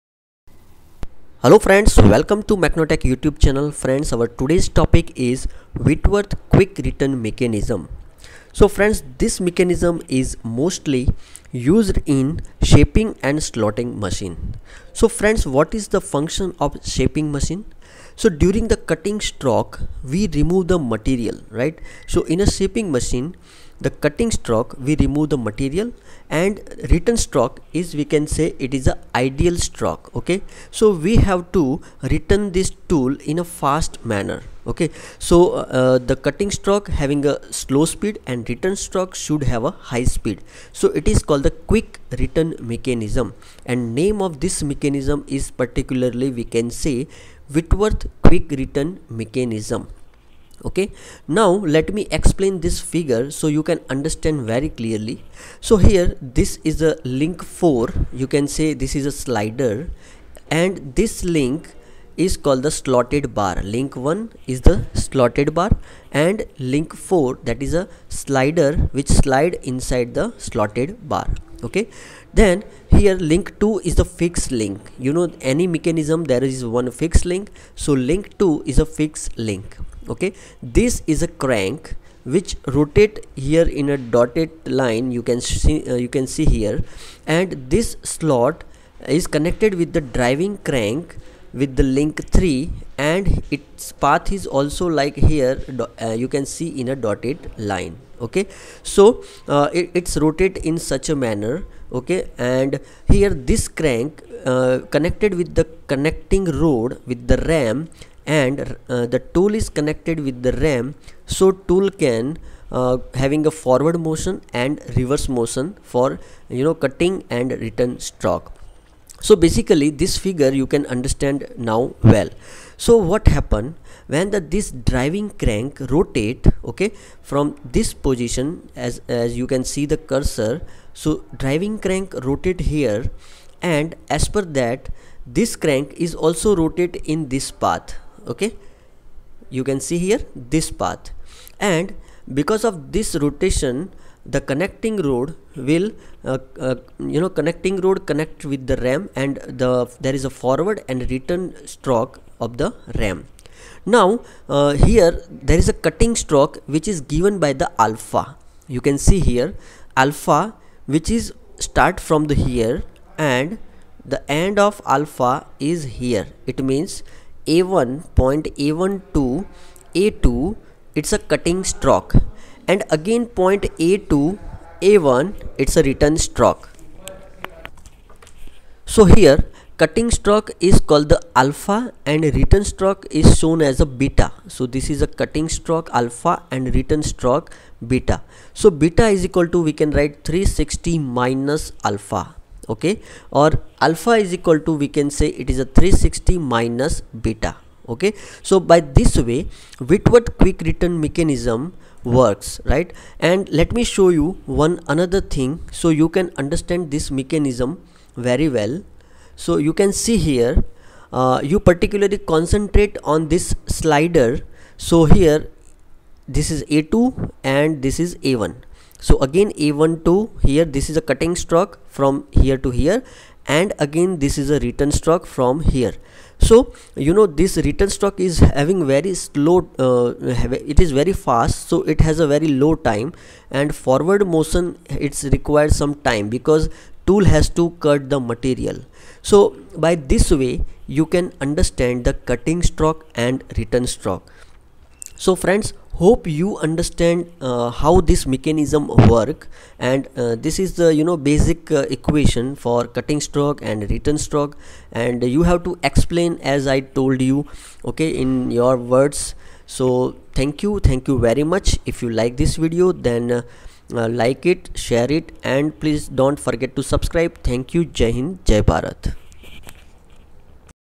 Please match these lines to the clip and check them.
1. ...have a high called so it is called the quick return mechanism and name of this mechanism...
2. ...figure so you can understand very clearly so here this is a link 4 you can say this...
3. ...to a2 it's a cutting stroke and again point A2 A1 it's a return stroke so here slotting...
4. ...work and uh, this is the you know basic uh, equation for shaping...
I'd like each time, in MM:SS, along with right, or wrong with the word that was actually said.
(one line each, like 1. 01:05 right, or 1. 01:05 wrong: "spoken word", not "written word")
1. 00:39 wrong: "speed", not "called"
2. 00:52 right
3. 02:49 wrong: "cutting", not "slotting"
4. 04:09 wrong: "cutting", not "shaping".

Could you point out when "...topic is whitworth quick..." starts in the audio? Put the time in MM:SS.
00:04.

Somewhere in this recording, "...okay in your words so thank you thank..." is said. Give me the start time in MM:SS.
04:17.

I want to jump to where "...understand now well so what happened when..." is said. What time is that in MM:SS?
02:00.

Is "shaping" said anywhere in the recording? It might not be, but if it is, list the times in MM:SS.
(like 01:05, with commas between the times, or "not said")
00:12, 00:16, 00:22.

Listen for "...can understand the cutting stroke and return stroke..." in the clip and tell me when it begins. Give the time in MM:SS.
04:01.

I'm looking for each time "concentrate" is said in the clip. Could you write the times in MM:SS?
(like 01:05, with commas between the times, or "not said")
03:32.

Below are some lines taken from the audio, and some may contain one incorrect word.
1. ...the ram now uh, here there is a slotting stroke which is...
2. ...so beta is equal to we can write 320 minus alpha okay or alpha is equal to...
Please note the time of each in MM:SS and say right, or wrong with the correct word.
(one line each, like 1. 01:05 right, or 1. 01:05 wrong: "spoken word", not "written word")
1. 02:32 wrong: "cutting", not "slotting"
2. 03:08 wrong: "360", not "320".